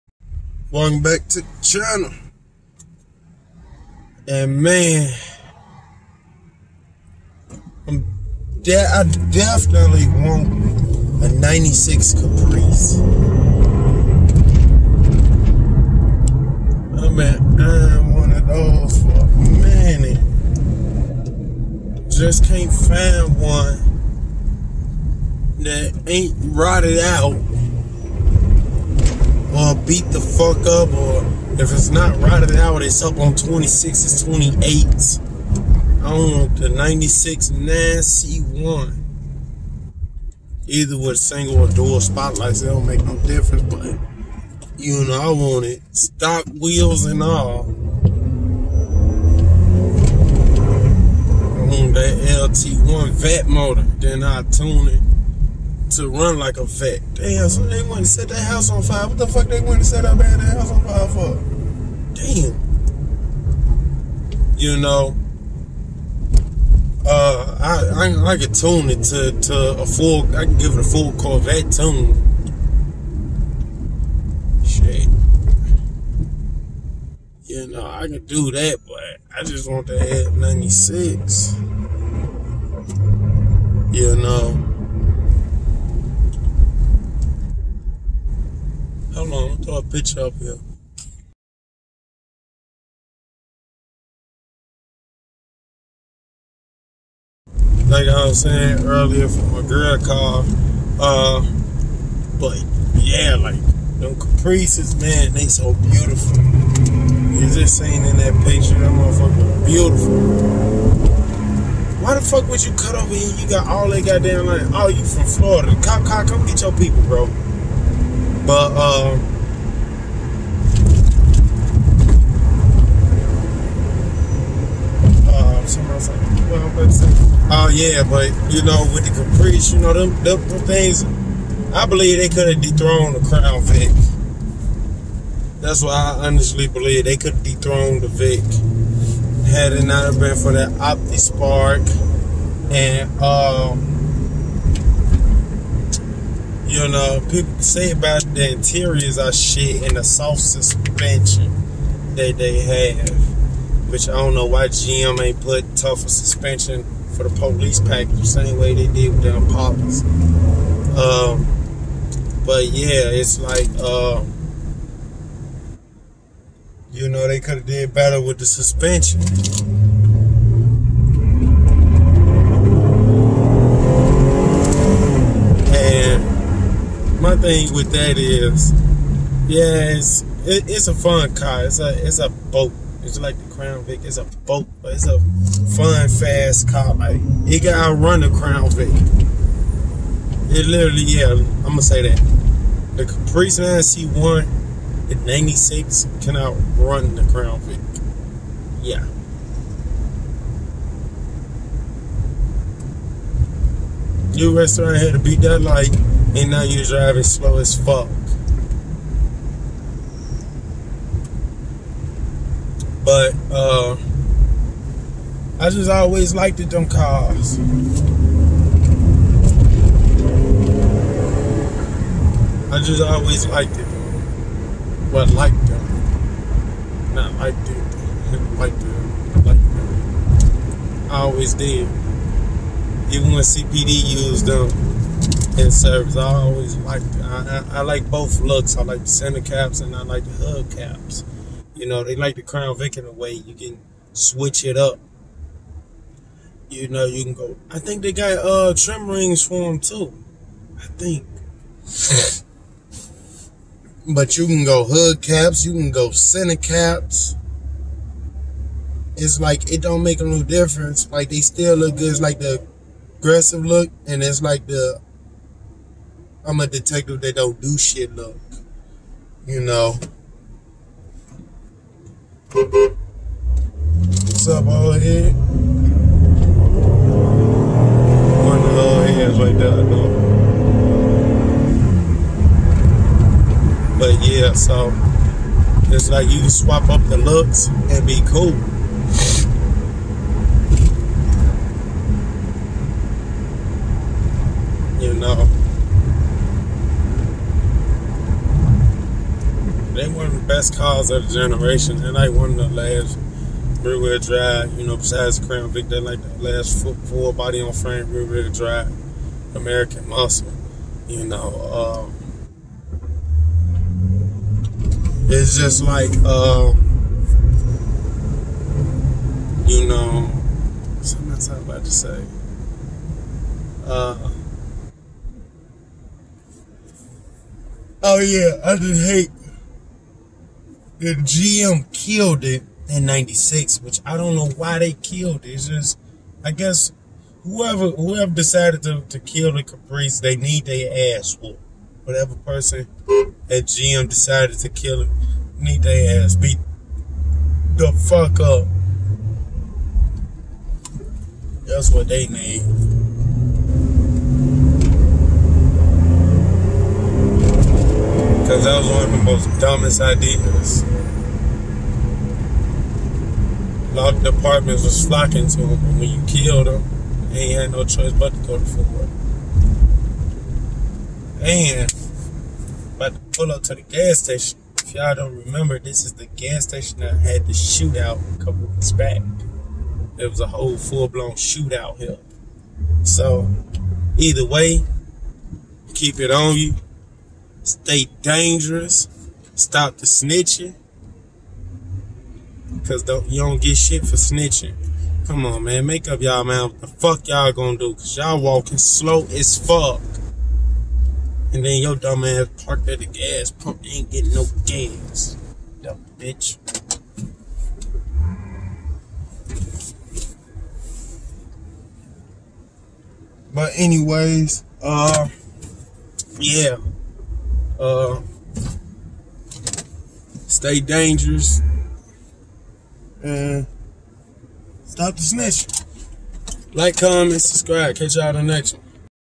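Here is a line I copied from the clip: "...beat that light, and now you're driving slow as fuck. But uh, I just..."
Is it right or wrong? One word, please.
right.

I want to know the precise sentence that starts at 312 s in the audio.
Um, it's just like, um, you know, something else I'm about to say.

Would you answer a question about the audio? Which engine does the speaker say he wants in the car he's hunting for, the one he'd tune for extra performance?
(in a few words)
LT1 Vette motor.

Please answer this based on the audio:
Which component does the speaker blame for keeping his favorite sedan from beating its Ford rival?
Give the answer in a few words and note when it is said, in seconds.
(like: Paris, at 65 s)
Opti Spark, at 140 s.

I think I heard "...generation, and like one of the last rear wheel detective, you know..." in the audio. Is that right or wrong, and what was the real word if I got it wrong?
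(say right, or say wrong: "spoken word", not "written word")
wrong: "drive", not "detective".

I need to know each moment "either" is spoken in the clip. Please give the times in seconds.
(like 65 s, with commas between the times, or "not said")
40 s, 384 s.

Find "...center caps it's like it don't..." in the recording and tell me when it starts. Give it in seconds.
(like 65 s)
256 s.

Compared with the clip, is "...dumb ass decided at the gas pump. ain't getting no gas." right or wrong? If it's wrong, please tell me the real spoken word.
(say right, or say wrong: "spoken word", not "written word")
wrong: "parked", not "decided".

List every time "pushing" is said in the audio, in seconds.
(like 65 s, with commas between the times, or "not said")
not said.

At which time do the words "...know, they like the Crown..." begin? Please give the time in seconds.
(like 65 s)
241 s.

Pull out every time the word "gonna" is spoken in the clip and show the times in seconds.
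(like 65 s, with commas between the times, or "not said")
191 s, 397 s.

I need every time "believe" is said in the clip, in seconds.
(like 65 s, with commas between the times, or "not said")
131 s, 136 s.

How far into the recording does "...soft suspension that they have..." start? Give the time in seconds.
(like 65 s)
150 s.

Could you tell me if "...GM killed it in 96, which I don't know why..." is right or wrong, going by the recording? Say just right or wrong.
right.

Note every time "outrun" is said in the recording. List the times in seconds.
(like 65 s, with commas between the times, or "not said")
187 s, 196 s.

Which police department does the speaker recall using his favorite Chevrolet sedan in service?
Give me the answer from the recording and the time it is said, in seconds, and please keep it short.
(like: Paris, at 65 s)
CPD, at 233 s.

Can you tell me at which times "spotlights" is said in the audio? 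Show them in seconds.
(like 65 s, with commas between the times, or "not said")
42 s.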